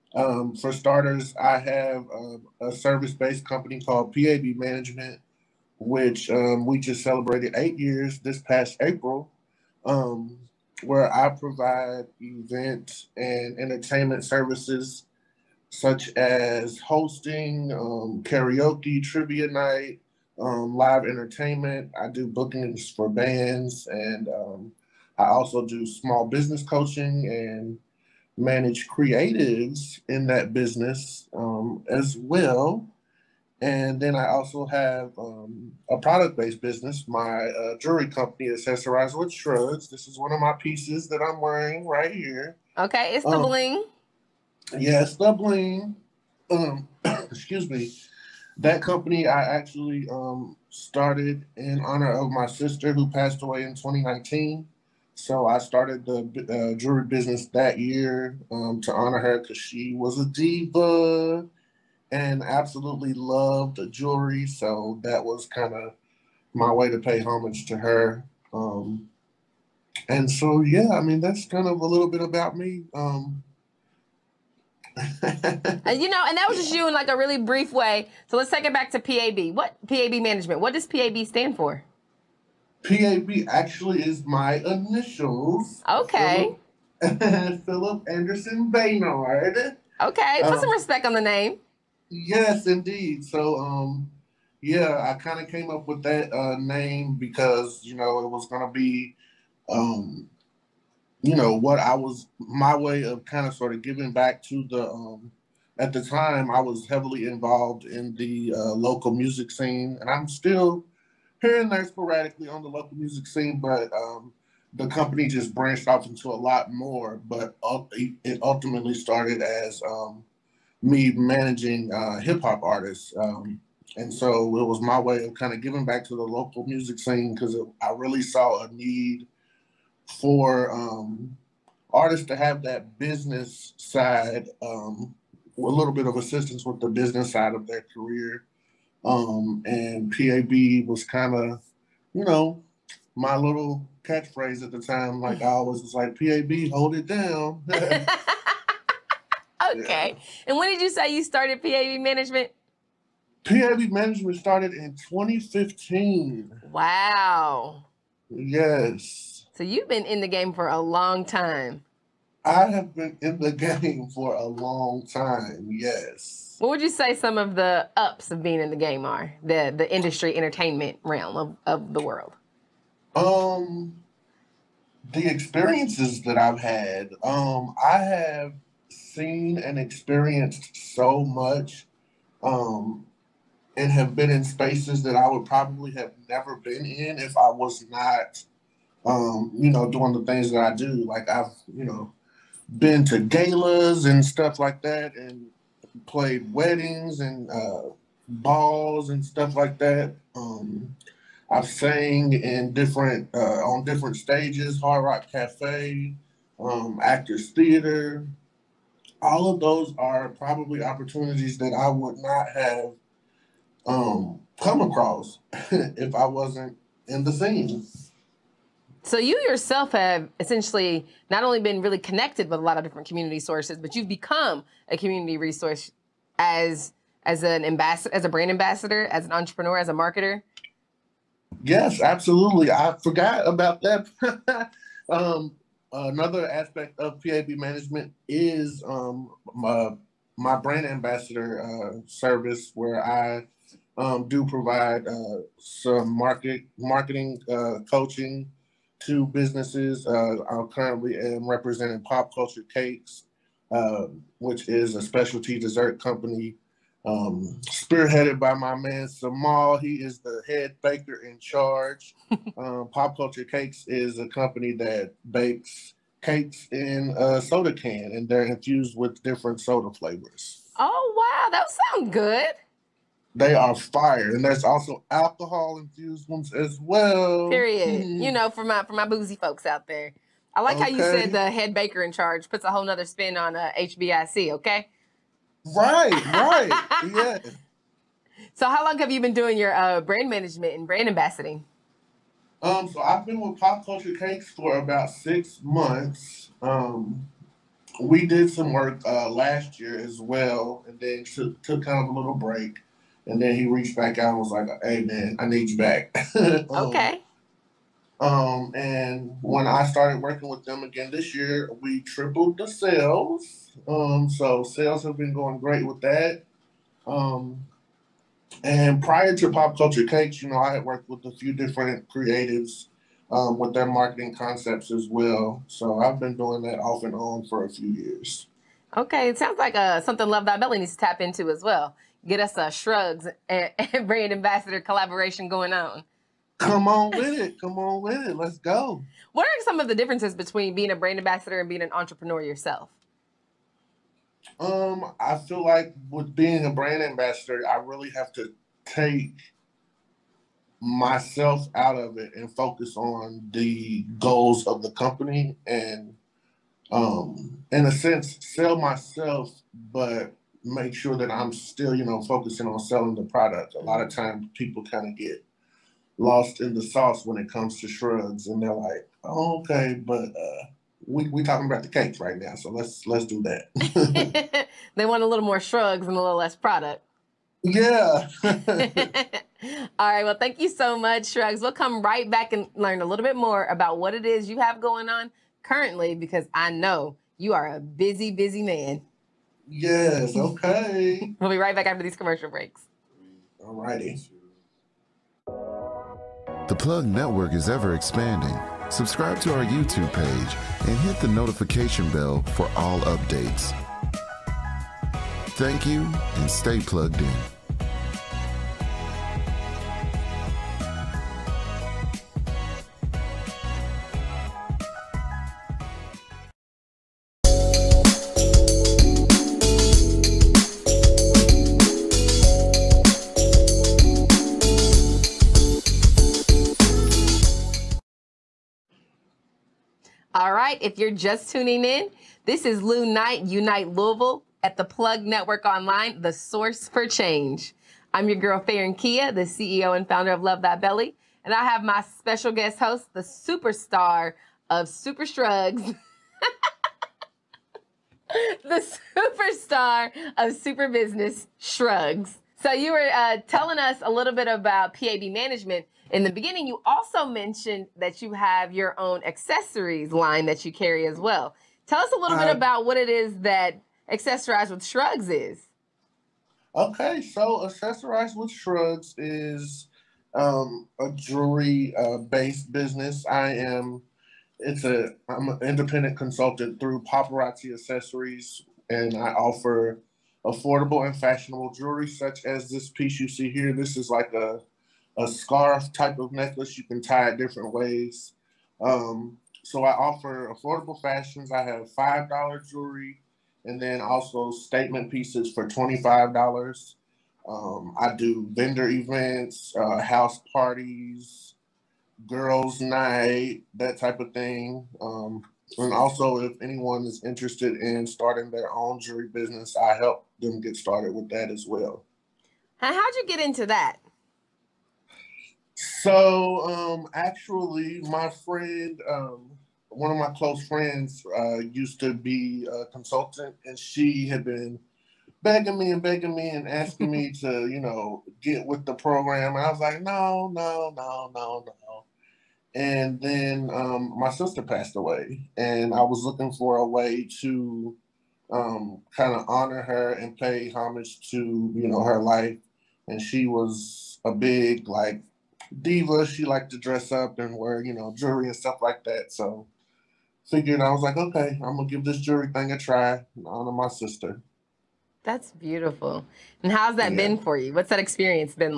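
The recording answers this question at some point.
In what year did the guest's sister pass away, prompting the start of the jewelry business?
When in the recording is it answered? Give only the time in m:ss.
0:53.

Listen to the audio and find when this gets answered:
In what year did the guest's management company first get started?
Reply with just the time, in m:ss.
2:34.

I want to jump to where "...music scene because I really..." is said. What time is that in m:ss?
2:06.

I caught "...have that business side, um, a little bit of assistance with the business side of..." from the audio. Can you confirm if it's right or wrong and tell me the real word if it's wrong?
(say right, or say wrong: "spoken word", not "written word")
right.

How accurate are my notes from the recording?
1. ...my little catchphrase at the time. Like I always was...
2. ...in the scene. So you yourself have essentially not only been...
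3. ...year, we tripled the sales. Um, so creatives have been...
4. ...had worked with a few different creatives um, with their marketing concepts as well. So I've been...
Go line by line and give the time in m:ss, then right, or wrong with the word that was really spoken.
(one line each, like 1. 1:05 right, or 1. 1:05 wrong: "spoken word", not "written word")
1. 2:23 right
2. 3:37 right
3. 5:11 wrong: "sales", not "creatives"
4. 5:20 right.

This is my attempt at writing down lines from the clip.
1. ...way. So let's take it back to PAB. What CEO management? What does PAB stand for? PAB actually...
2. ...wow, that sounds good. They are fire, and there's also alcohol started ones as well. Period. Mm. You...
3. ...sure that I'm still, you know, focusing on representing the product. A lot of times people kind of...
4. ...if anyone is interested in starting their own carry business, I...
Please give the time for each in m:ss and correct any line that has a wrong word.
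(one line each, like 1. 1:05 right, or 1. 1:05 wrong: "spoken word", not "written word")
1. 1:17 wrong: "PAB", not "CEO"
2. 4:31 wrong: "infused", not "started"
3. 6:00 wrong: "selling", not "representing"
4. 8:26 wrong: "jewelry", not "carry".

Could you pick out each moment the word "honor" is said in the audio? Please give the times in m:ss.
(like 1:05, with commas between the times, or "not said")
0:51, 0:58, 8:59, 9:13.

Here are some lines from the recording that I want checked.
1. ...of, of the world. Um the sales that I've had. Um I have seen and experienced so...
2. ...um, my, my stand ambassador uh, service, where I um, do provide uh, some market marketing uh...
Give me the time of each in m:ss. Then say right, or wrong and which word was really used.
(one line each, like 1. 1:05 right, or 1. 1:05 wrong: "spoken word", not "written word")
1. 2:51 wrong: "experiences", not "sales"
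2. 3:58 wrong: "brand", not "stand".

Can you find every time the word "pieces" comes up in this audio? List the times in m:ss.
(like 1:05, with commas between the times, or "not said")
0:40, 8:02, 8:15.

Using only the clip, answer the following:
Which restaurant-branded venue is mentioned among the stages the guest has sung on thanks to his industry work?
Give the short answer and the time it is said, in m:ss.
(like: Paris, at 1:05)
Hard Rock Cafe, at 3:24.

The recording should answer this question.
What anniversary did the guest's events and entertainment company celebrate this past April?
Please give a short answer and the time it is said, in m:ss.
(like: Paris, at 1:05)
8, at 0:07.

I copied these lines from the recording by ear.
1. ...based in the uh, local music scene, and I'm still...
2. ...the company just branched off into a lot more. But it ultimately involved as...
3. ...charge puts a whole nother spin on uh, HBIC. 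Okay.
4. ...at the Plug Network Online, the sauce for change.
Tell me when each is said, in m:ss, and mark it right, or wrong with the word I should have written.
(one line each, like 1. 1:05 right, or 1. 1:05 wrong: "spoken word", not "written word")
1. 1:47 wrong: "involved", not "based"
2. 1:54 wrong: "started", not "involved"
3. 4:42 right
4. 7:14 wrong: "source", not "sauce".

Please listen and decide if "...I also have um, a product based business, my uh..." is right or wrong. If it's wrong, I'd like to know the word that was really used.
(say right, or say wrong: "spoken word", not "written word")
right.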